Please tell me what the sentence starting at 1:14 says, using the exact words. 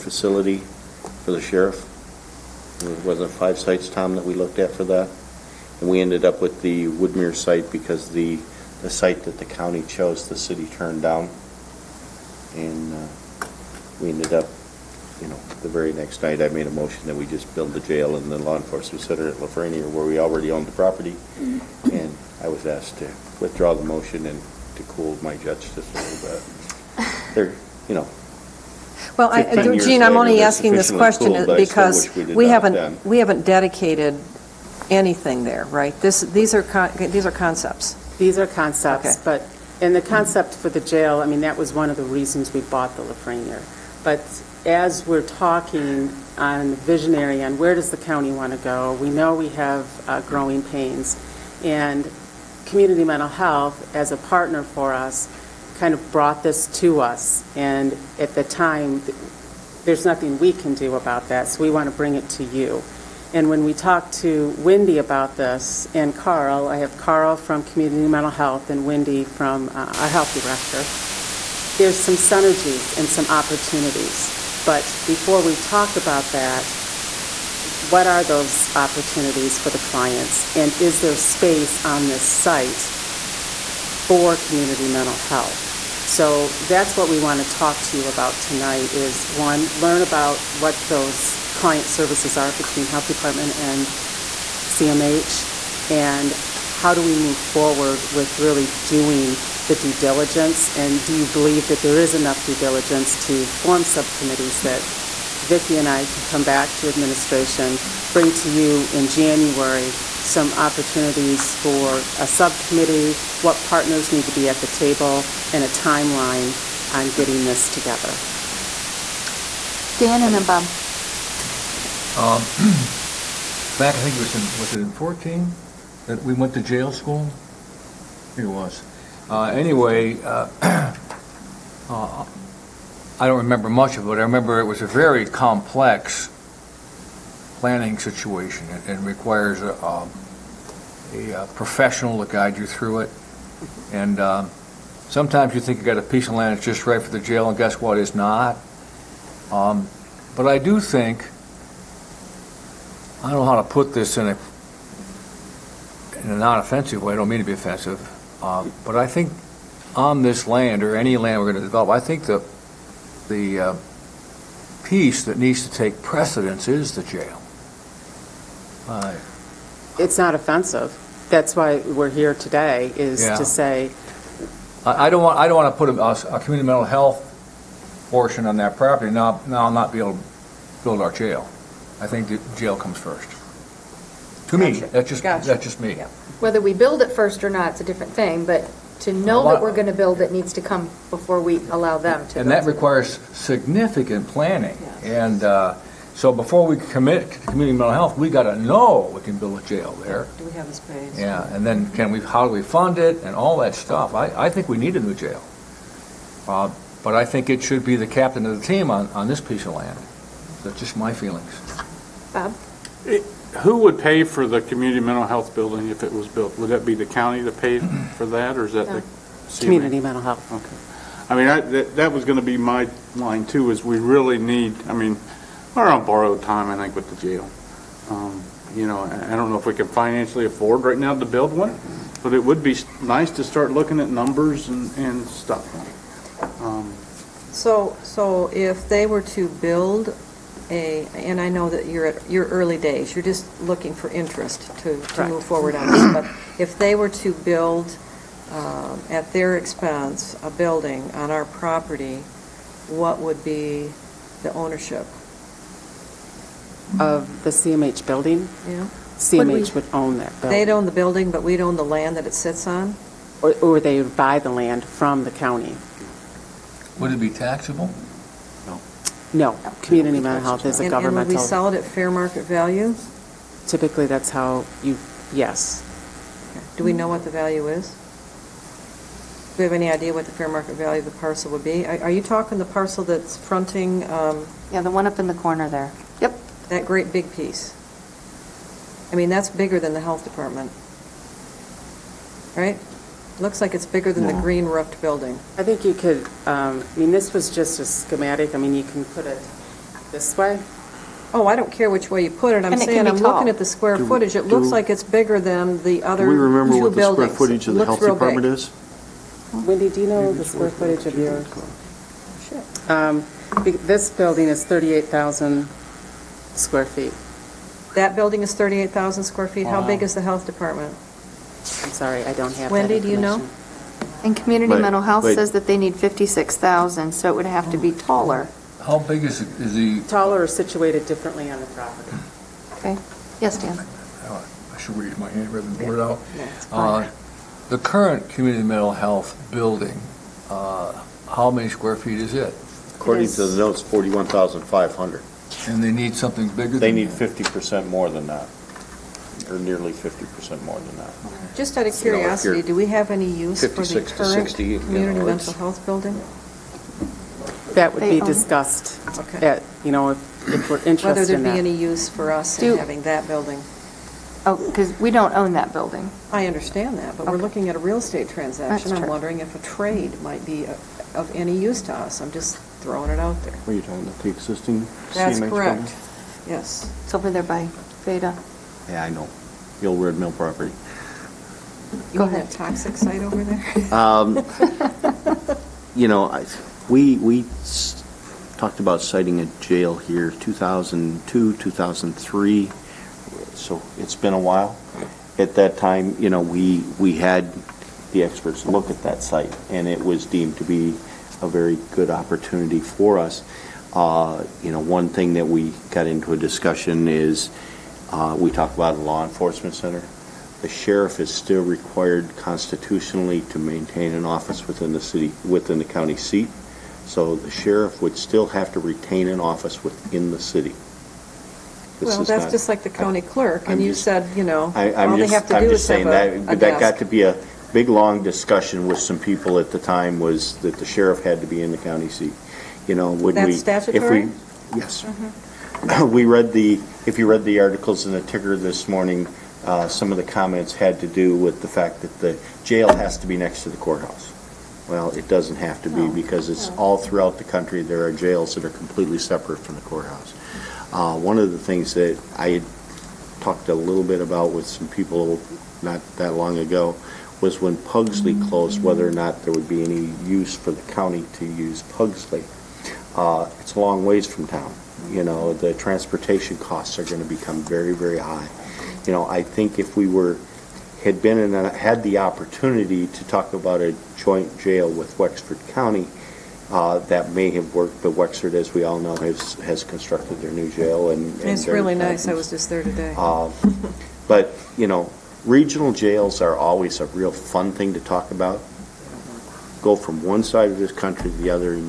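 But before we talk about that, what are those opportunities for the clients?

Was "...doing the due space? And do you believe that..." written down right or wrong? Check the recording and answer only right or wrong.
wrong.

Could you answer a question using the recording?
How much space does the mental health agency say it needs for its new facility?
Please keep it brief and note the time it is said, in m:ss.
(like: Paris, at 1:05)
56,000, at 5:25.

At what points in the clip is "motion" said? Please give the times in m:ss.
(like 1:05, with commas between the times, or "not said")
0:16, 0:23.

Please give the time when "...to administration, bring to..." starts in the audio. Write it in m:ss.
1:46.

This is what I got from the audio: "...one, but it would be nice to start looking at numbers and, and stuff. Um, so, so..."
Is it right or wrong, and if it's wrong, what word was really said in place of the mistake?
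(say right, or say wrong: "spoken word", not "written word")
right.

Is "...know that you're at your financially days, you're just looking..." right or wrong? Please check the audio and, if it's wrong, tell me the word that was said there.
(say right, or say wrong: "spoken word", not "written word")
wrong: "early", not "financially".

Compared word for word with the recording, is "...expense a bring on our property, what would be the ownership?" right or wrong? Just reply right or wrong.
wrong.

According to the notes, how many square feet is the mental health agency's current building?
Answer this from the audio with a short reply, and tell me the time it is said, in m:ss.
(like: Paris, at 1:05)
41,500, at 5:43.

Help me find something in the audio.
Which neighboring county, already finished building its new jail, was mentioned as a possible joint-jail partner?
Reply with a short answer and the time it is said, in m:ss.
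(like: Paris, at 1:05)
Wexford County, at 7:55.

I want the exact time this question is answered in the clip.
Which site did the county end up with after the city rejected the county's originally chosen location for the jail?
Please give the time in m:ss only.
0:06.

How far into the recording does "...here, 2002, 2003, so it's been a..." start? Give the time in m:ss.
6:29.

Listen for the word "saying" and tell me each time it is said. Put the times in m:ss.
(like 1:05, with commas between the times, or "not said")
5:02, 7:05.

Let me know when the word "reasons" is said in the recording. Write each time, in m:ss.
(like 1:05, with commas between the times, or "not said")
0:42.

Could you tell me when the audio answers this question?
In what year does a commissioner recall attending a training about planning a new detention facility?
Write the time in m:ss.
2:04.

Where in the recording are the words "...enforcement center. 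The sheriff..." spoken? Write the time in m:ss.
6:49.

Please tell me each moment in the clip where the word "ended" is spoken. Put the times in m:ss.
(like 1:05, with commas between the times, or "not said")
0:06, 0:14.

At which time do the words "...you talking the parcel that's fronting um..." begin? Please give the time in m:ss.
4:42.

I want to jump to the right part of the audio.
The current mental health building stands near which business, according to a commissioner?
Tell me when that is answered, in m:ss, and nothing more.
6:18.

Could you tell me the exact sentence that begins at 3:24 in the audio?
I, I think we need a new jail.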